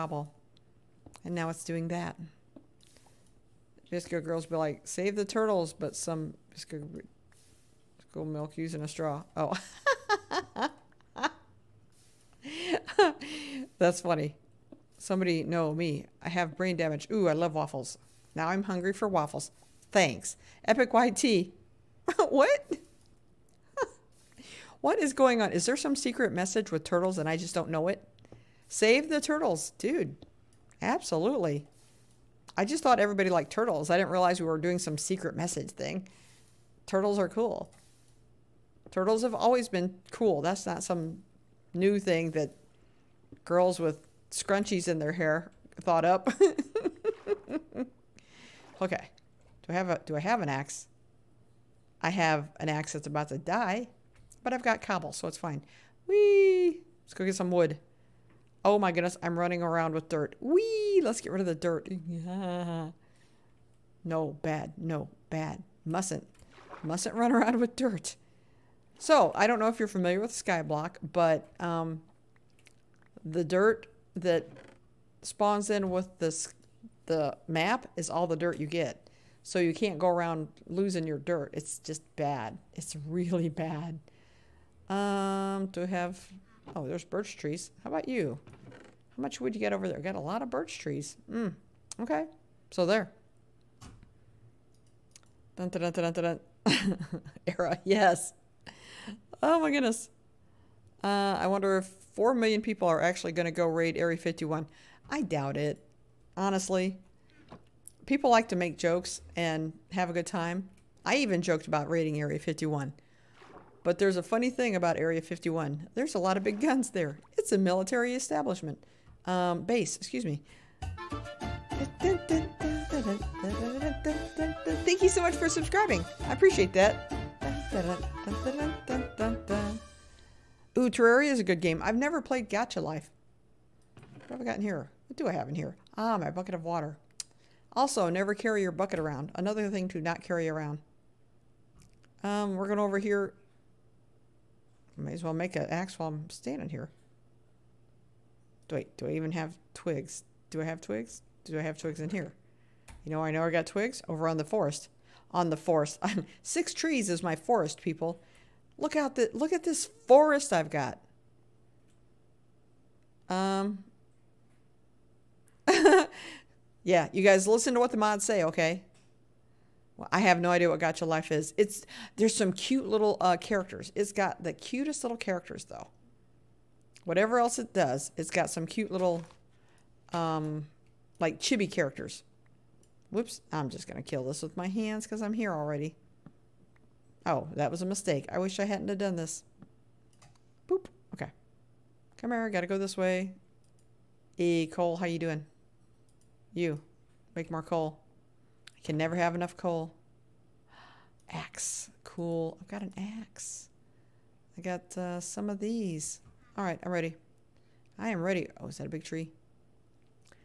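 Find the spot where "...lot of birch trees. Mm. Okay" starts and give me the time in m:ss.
1:30.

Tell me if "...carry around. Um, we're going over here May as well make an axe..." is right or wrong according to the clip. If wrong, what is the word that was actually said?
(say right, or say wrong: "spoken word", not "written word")
right.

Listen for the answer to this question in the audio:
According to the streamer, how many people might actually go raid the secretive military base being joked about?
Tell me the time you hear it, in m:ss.
1:42.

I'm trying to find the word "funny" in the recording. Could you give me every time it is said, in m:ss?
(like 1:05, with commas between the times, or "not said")
0:13, 1:54.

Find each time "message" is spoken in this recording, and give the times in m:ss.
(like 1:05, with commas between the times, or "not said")
0:26, 0:35.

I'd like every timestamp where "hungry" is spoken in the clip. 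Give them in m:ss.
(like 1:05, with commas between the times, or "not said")
0:18.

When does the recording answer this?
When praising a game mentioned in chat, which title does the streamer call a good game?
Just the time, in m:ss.
2:10.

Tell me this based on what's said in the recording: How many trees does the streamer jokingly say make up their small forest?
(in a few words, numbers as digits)
6.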